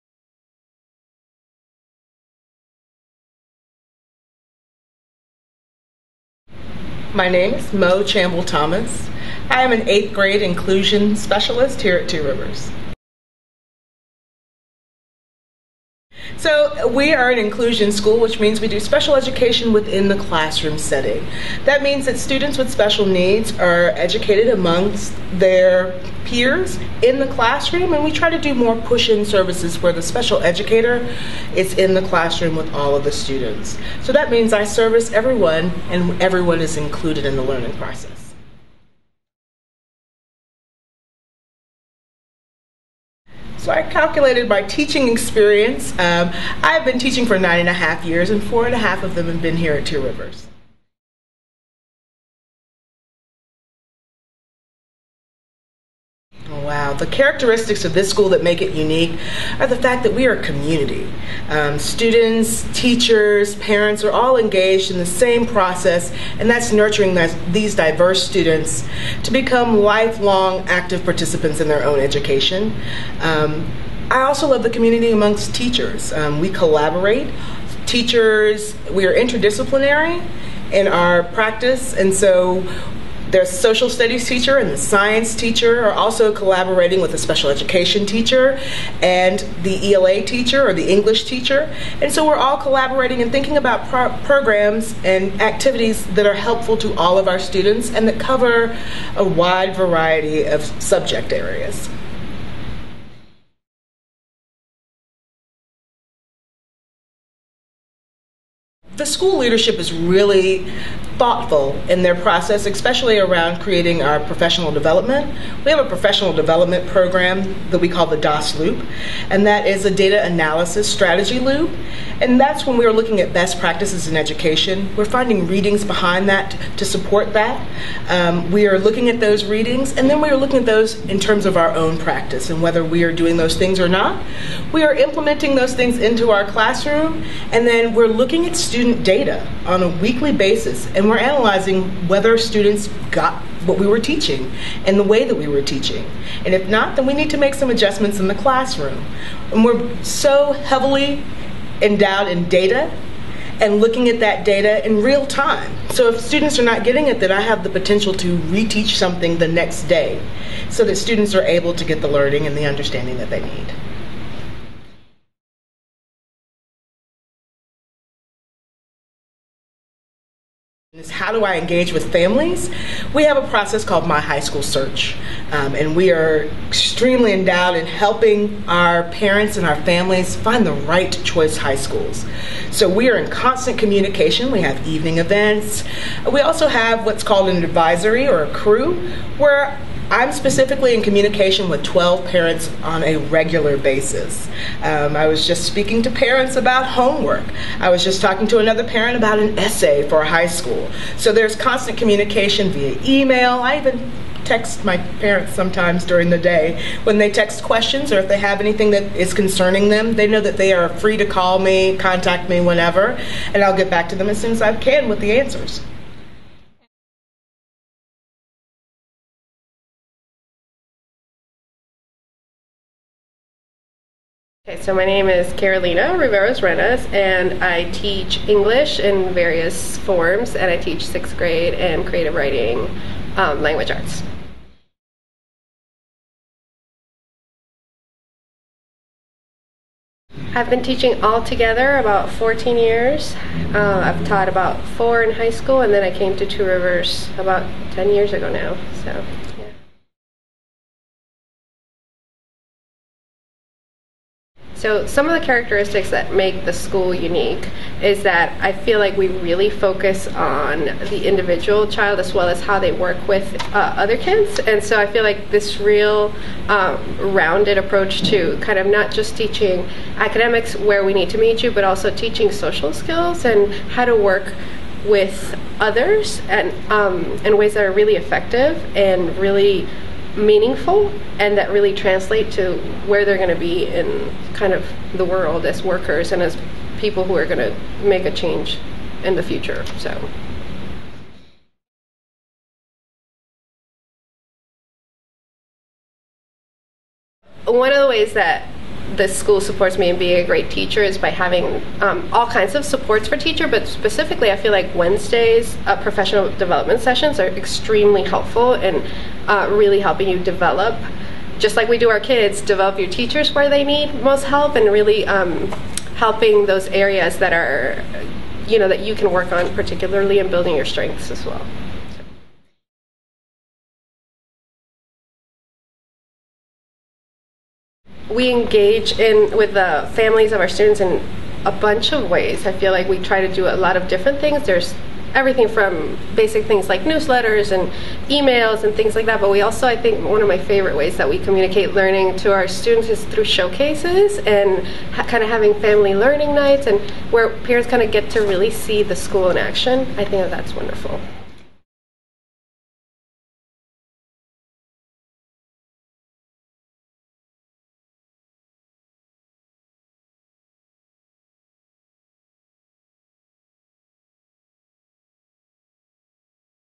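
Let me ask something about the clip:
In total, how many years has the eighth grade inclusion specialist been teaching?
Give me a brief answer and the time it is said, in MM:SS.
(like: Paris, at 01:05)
9 and a half years, at 00:47.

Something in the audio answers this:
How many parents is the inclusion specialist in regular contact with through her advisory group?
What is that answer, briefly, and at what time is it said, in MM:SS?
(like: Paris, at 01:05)
12, at 03:11.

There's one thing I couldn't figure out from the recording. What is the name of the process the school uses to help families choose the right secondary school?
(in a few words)
My High School Search.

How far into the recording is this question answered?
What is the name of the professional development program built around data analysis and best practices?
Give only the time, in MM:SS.
01:58.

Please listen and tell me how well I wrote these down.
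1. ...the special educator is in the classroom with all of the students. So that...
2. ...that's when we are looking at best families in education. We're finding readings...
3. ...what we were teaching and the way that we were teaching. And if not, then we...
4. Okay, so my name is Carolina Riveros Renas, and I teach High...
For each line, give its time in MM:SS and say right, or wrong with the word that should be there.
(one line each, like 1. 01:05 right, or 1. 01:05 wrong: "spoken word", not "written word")
1. 00:29 right
2. 02:02 wrong: "practices", not "families"
3. 02:23 right
4. 03:44 wrong: "English", not "High".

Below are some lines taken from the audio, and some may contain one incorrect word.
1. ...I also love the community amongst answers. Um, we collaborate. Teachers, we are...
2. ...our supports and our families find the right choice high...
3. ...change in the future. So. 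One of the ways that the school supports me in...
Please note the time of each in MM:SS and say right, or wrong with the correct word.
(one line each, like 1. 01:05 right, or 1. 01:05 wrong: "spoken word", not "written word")
1. 01:14 wrong: "teachers", not "answers"
2. 02:58 wrong: "parents", not "supports"
3. 04:48 right.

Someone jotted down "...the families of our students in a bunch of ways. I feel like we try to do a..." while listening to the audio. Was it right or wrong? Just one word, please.
right.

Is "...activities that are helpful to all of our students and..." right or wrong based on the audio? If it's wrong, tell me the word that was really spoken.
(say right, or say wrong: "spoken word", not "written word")
right.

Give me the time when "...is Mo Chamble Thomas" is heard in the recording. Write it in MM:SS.
00:07.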